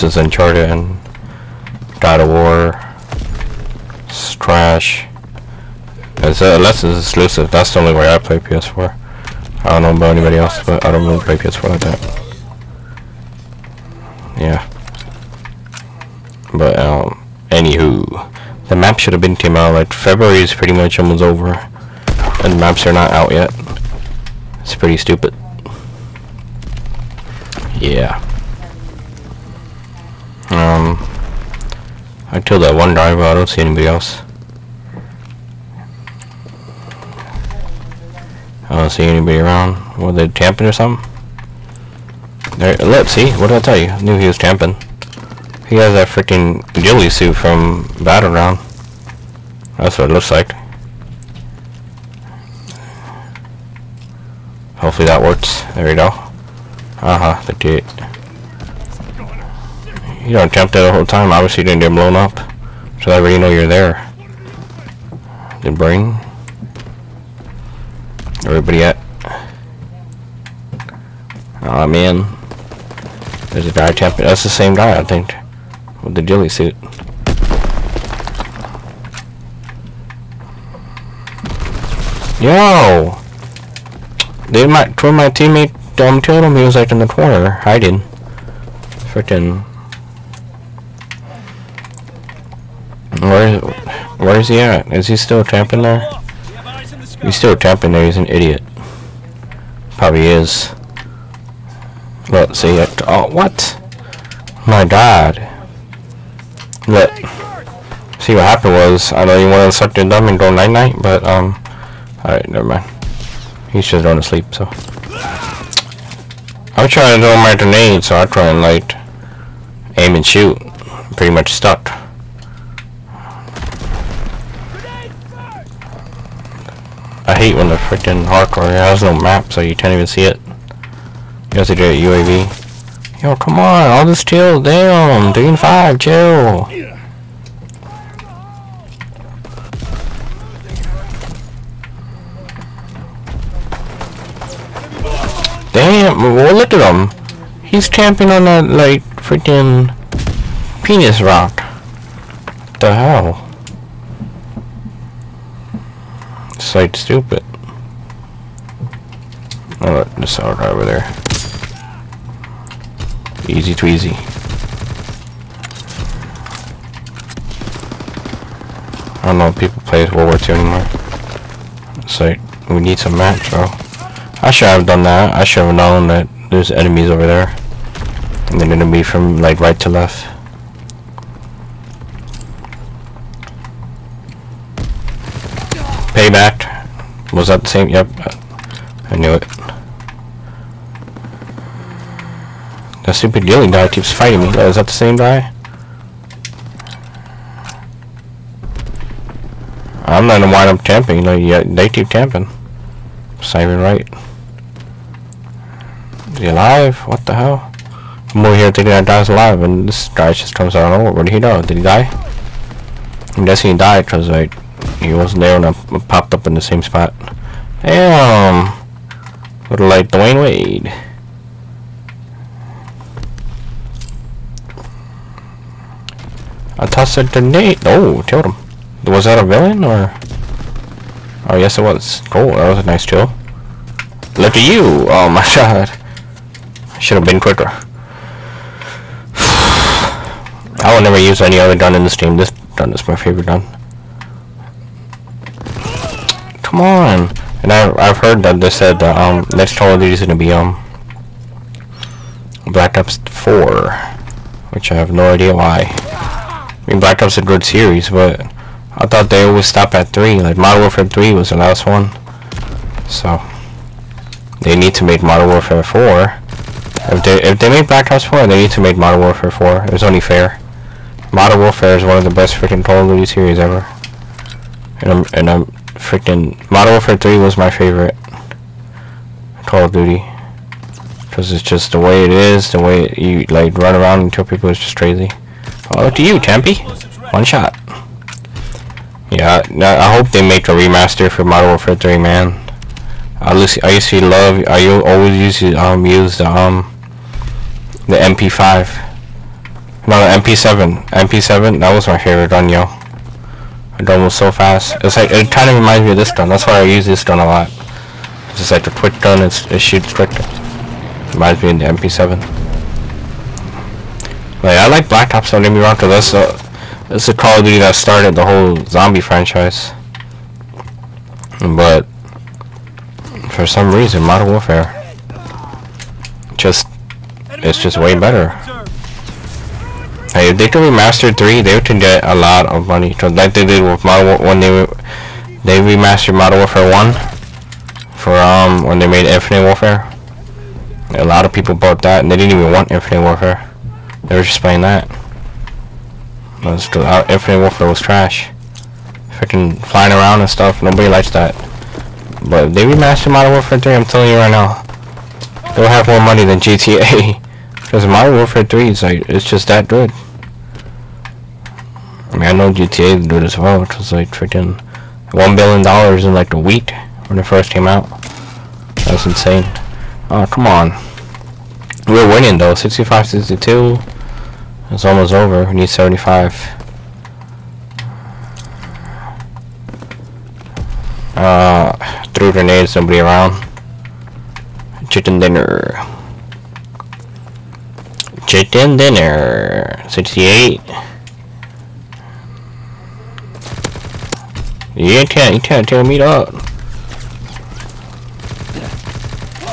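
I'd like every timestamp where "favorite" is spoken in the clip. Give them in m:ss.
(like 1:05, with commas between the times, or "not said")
4:03, 4:37, 5:02.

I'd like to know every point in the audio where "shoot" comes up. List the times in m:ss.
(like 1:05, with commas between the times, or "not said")
2:00, 5:09.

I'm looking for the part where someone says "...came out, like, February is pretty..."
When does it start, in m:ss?
0:19.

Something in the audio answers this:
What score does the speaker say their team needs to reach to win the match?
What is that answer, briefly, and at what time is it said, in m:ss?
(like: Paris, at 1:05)
75, at 6:15.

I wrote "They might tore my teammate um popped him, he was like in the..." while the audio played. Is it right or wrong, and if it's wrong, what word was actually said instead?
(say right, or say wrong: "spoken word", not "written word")
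wrong: "killed", not "popped".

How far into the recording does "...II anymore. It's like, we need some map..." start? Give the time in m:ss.
2:50.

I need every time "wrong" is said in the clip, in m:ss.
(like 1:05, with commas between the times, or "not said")
5:15.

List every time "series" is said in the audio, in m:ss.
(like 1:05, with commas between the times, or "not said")
4:17, 4:33.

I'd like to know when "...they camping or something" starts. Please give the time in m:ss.
0:40.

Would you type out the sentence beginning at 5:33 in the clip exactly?
So like they did with Modern War when they they remastered Modern Warfare One for um when they made Infinite Warfare.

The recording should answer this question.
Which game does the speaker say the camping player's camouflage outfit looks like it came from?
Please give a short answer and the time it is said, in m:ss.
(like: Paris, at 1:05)
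Battleground, at 0:48.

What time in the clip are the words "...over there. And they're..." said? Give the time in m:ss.
2:57.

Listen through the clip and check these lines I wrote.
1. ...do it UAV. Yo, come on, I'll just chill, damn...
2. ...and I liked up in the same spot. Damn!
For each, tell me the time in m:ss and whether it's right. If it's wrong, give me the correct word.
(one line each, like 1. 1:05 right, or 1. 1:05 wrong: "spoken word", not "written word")
1. 2:11 right
2. 3:35 wrong: "popped", not "liked".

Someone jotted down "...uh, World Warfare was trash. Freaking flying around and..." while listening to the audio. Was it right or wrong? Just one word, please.
wrong.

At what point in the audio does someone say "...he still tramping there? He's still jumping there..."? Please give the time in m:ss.
1:35.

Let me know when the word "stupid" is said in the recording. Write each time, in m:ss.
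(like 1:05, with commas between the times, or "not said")
0:24, 2:36, 3:13.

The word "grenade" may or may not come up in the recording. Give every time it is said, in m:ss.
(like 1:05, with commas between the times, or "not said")
1:57, 3:47, 6:22.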